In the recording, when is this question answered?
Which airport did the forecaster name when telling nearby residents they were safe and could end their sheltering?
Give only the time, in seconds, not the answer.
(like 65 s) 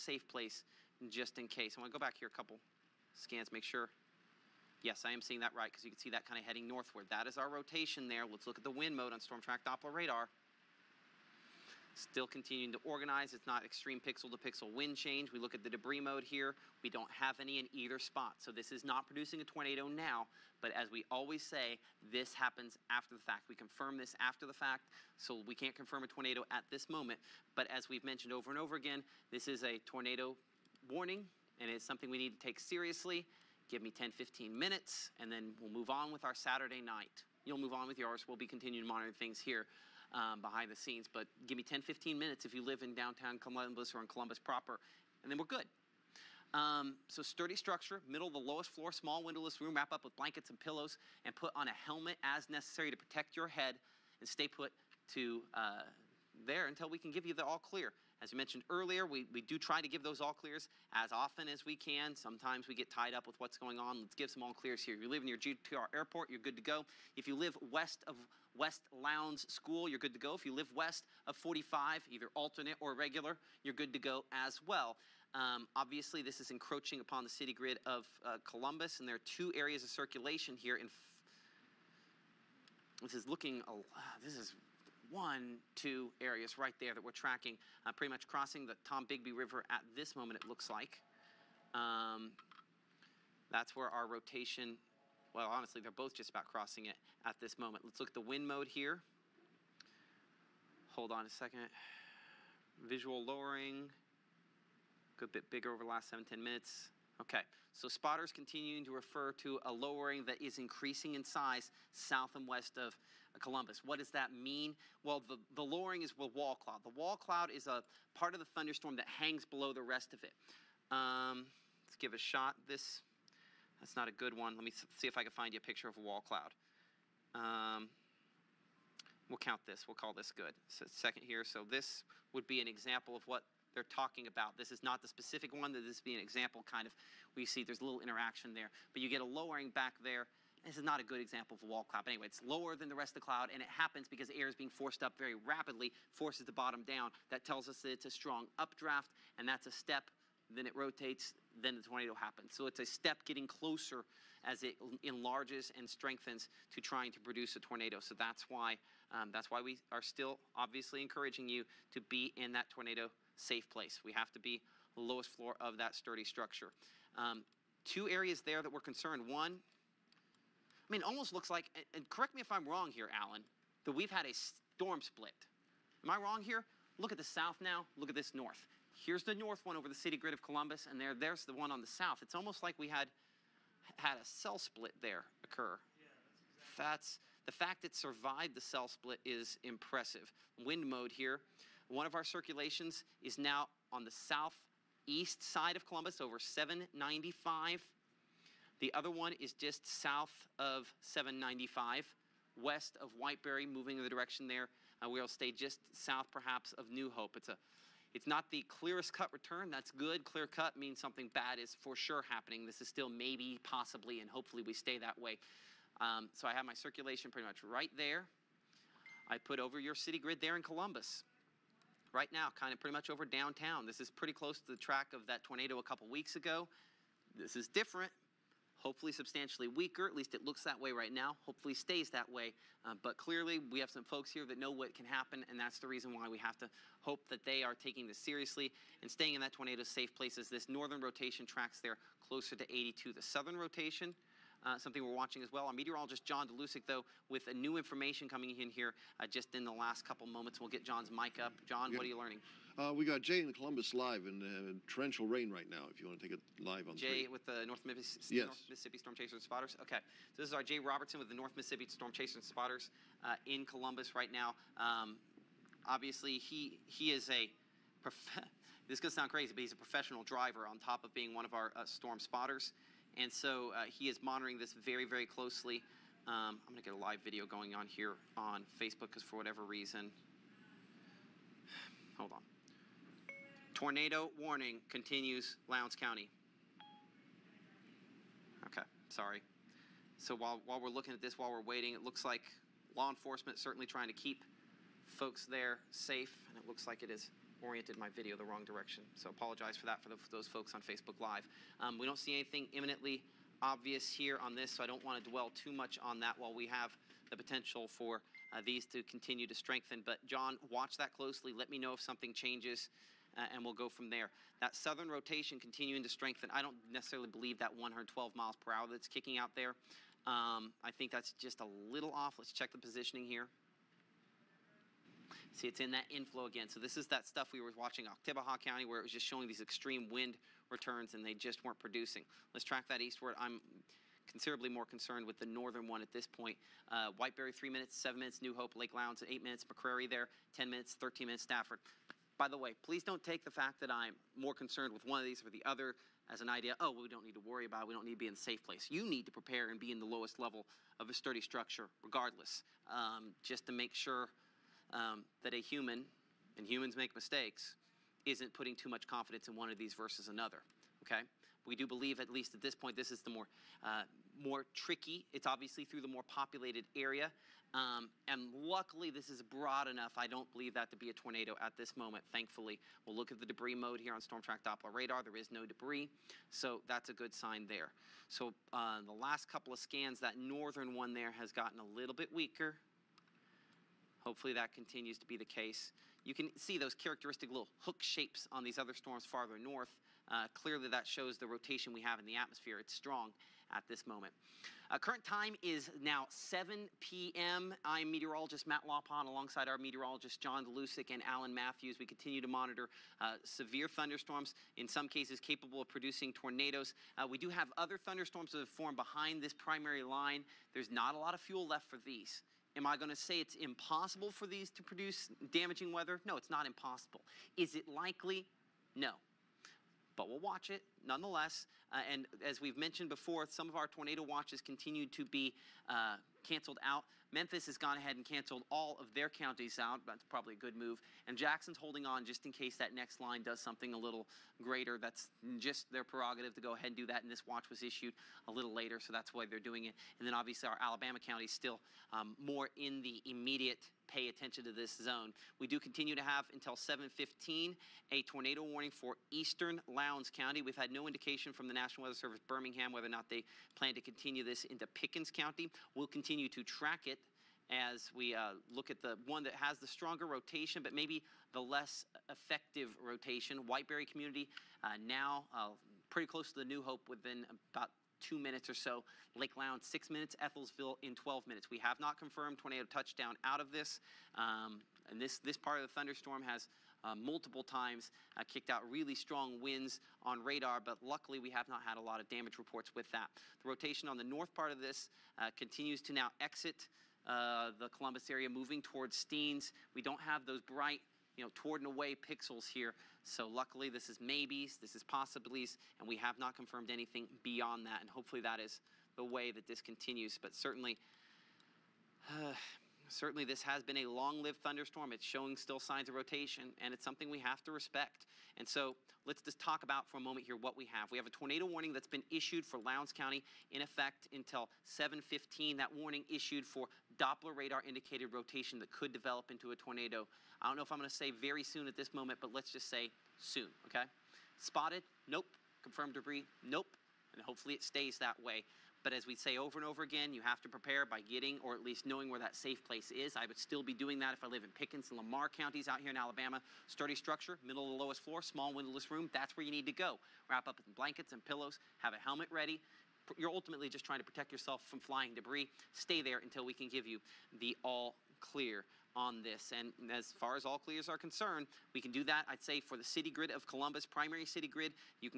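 65 s.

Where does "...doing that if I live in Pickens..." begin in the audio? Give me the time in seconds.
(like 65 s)
533 s.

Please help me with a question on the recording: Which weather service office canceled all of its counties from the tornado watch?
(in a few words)
Memphis.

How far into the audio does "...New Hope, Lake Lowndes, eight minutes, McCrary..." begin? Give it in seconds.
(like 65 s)
338 s.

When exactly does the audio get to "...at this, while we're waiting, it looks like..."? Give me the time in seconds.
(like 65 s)
291 s.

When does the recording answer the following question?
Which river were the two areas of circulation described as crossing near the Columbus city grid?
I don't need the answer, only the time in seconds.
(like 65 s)
88 s.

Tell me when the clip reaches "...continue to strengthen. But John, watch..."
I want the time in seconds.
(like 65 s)
309 s.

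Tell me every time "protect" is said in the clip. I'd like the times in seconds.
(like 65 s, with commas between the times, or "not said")
52 s, 544 s.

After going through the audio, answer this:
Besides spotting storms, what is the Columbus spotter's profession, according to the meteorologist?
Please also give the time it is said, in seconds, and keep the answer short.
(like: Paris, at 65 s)
Professional driver, at 269 s.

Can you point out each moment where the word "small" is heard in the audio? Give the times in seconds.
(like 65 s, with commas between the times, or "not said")
48 s, 538 s.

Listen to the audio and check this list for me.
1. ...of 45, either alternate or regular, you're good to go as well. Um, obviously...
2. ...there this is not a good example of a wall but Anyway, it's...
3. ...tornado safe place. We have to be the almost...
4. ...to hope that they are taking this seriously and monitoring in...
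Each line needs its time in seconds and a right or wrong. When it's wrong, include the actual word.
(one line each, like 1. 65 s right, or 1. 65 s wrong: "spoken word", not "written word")
1. 71 s right
2. 140 s right
3. 162 s wrong: "lowest", not "almost"
4. 236 s wrong: "staying", not "monitoring".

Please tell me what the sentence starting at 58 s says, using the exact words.
As we mentioned earlier, we, we do try to give those all clears as often as we can.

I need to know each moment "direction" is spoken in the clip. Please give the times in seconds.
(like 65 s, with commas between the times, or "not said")
204 s, 298 s.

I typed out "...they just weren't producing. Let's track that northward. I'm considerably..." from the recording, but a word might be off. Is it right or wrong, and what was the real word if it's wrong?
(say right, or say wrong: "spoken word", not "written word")
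wrong: "eastward", not "northward".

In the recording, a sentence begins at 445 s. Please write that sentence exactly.
We do continue to have until 7:15 a tornado warning for eastern Lowndes County.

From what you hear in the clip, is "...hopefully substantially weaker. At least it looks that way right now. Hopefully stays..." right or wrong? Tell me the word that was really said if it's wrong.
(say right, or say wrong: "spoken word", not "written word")
right.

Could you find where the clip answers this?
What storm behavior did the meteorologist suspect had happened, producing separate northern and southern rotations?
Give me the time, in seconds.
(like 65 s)
174 s.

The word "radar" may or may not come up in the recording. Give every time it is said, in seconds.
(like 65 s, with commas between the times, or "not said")
9 s, 374 s, 480 s, 517 s.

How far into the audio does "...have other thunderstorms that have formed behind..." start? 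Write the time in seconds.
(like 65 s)
407 s.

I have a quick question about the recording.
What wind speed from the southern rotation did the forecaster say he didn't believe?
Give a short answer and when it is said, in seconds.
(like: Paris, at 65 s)
112 mph, at 317 s.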